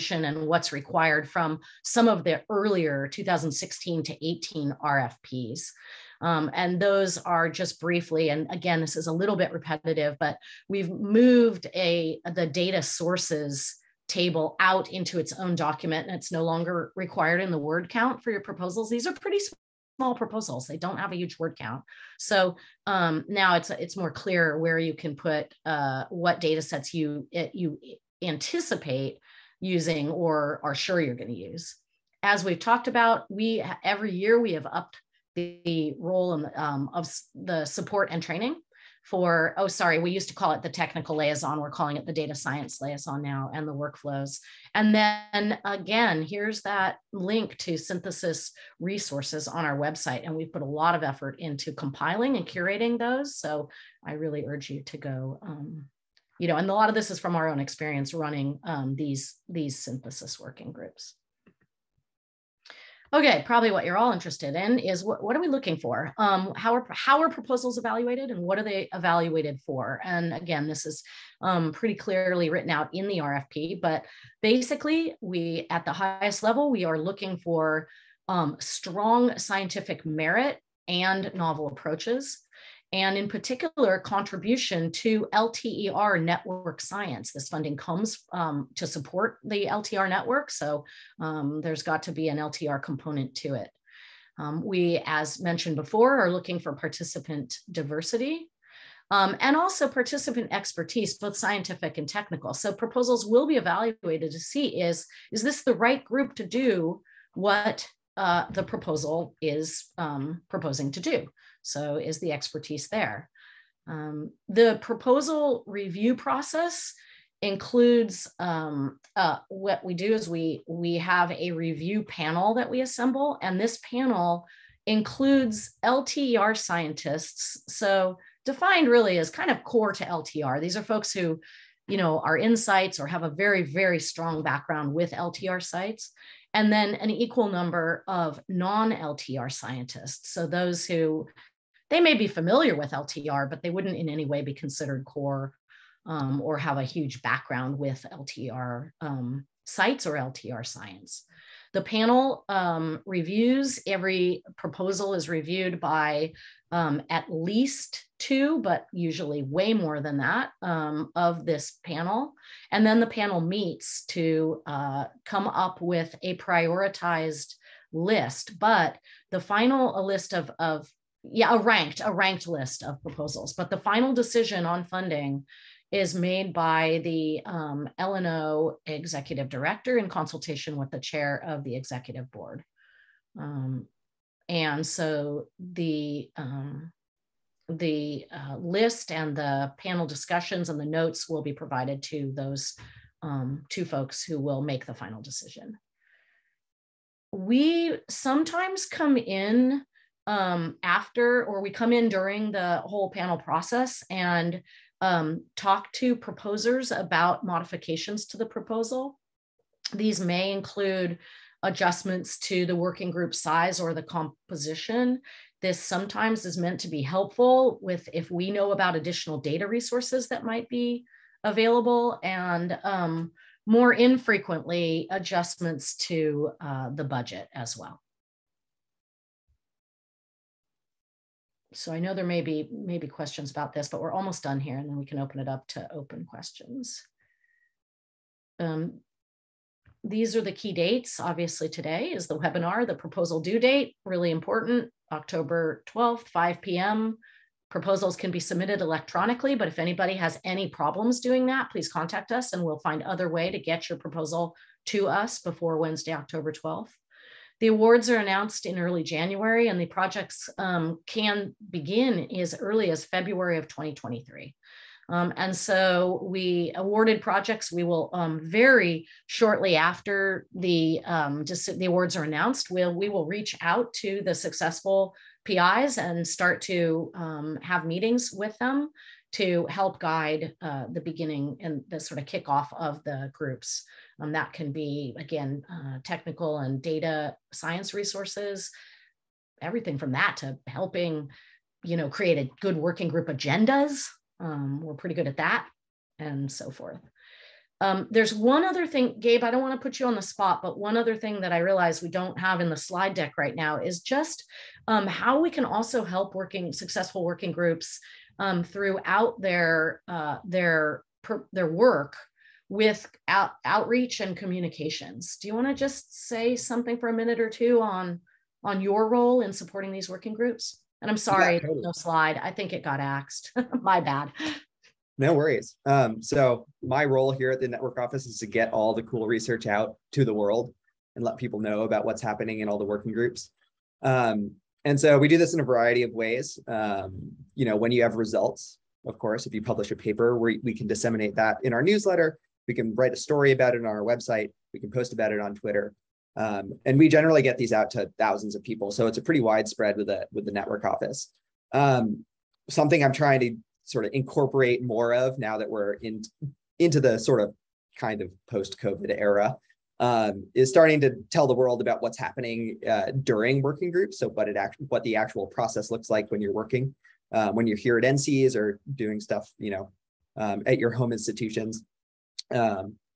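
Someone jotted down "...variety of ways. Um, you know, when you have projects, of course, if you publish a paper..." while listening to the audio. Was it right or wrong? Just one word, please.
wrong.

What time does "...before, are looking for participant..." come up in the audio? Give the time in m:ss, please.
1:35.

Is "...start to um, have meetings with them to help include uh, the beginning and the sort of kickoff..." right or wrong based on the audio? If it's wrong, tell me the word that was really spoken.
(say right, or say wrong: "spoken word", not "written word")
wrong: "guide", not "include".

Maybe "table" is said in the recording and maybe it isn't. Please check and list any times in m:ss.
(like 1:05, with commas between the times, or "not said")
0:14.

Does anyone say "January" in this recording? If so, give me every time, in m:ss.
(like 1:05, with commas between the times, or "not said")
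4:19.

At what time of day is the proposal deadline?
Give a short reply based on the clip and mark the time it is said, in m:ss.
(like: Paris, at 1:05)
5 p.m., at 4:06.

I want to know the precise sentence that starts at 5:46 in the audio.
Um, and we generally get these out to thousands of people.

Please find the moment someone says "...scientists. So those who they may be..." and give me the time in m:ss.
2:19.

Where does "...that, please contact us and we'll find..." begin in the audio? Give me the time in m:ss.
4:11.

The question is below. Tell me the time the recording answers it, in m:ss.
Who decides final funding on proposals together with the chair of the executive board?
2:57.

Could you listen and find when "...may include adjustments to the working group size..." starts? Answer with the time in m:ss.
3:30.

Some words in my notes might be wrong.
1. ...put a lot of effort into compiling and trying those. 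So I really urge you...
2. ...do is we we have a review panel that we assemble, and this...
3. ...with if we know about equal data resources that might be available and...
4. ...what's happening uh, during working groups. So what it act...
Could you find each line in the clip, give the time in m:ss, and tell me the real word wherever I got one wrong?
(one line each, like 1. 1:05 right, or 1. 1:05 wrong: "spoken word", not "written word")
1. 0:50 wrong: "curating", not "trying"
2. 1:59 right
3. 3:37 wrong: "additional", not "equal"
4. 6:02 right.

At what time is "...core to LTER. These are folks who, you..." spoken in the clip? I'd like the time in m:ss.
2:09.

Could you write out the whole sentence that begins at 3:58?
Um, these are the key dates.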